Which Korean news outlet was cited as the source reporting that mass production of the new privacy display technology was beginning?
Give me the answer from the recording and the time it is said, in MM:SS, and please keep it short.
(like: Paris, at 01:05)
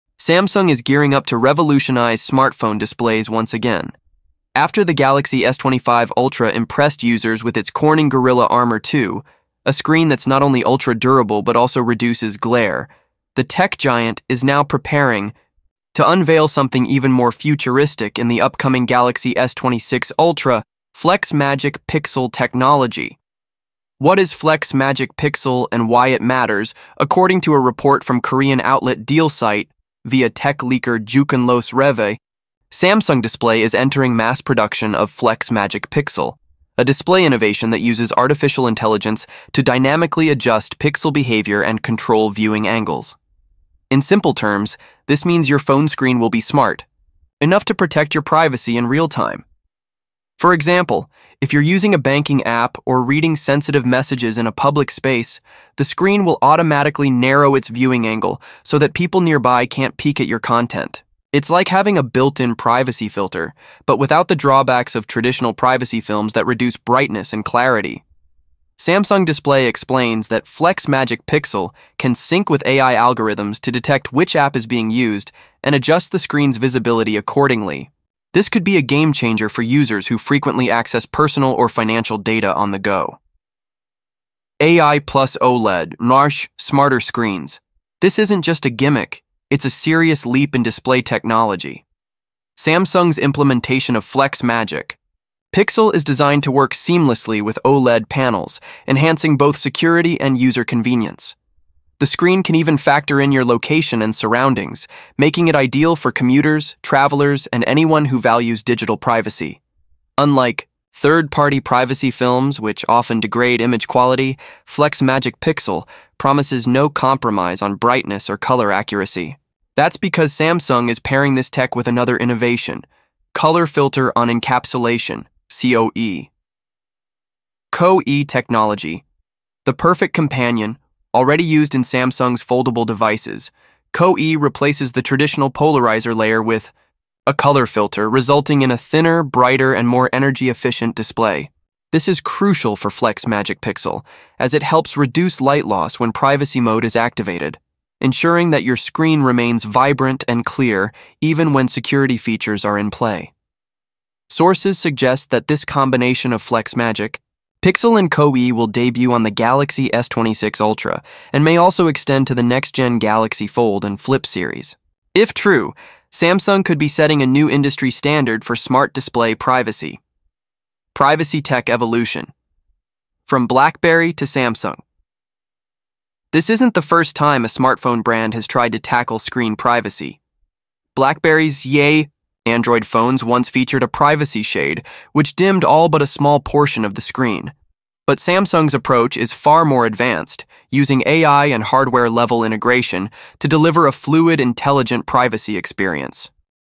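DealSite, at 00:29.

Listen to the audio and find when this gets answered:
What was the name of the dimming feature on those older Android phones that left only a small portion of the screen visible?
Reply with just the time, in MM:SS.
03:03.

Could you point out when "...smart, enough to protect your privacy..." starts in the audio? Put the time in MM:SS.
00:46.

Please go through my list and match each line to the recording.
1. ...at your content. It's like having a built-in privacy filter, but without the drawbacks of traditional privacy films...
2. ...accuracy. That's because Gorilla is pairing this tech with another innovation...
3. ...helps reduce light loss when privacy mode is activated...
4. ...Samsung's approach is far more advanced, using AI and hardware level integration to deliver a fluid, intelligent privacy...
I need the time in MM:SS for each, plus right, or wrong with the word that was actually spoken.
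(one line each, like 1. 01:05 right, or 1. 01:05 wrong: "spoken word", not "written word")
1. 01:00 right
2. 01:58 wrong: "Samsung", not "Gorilla"
3. 02:24 right
4. 03:08 right.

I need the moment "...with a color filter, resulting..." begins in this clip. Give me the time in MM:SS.
02:16.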